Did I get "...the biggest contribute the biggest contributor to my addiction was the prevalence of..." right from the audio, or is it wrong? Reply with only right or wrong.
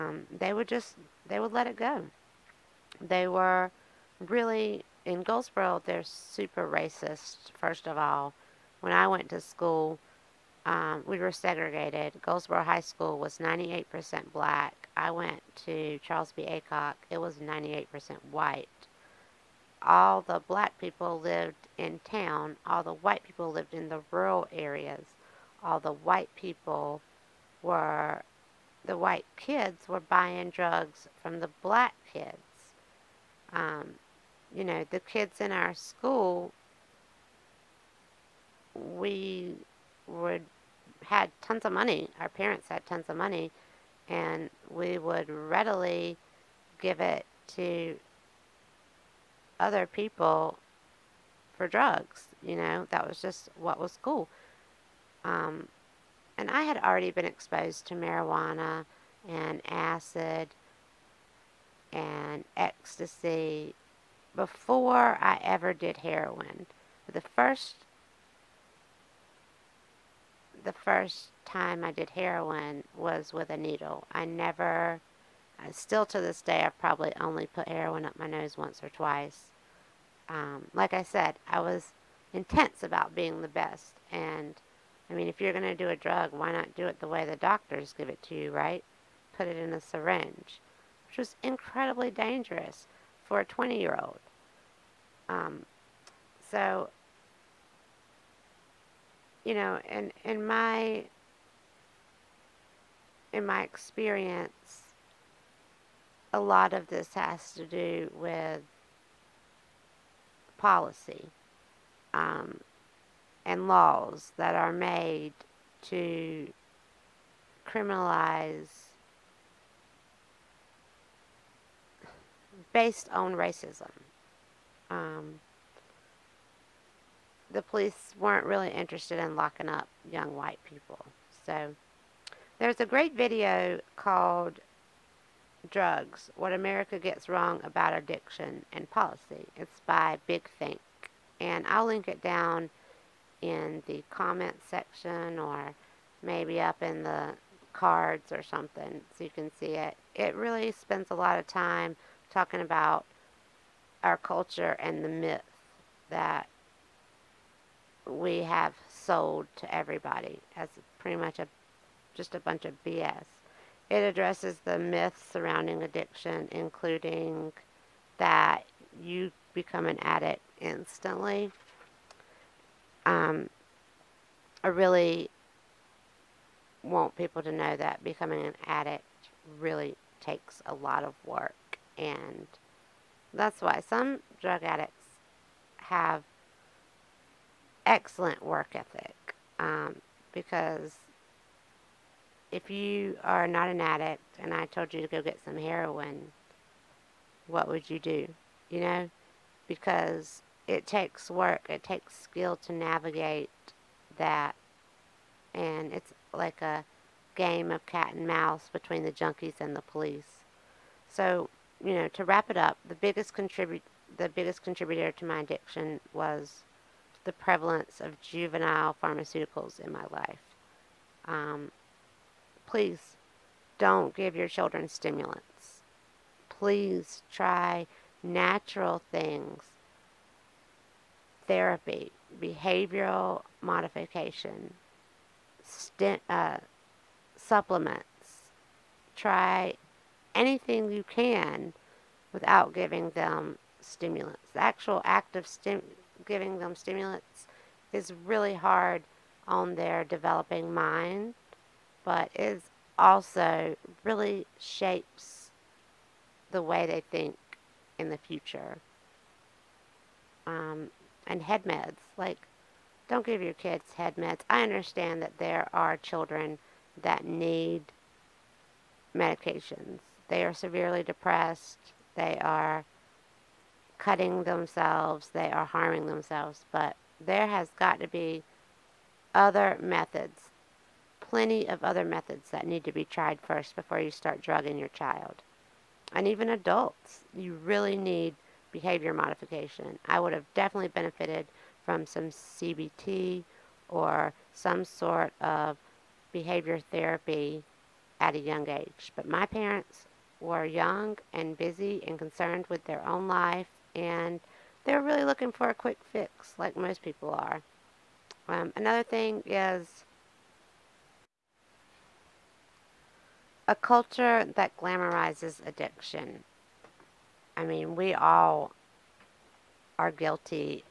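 right.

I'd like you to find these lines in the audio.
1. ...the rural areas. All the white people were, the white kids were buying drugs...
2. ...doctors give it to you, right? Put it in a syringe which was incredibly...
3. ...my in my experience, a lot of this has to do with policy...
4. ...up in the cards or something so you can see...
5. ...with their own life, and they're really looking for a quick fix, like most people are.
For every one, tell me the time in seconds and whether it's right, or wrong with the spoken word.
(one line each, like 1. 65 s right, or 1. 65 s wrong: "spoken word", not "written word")
1. 23 s right
2. 87 s right
3. 100 s right
4. 146 s right
5. 302 s right.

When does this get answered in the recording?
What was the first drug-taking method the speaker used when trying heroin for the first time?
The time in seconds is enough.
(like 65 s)
73 s.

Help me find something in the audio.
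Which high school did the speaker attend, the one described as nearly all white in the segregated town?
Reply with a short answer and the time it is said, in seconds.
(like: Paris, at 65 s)
Charles B. Aycock, at 15 s.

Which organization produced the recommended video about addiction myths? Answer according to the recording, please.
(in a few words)
Big Think.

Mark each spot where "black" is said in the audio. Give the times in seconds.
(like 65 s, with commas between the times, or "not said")
14 s, 20 s, 31 s.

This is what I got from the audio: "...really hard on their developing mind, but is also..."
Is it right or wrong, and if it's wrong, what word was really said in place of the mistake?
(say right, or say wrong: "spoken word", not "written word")
right.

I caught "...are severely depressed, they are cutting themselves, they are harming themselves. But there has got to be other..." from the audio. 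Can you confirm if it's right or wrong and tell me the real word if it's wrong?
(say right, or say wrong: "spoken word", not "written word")
right.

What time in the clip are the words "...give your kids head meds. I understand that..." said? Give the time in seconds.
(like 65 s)
263 s.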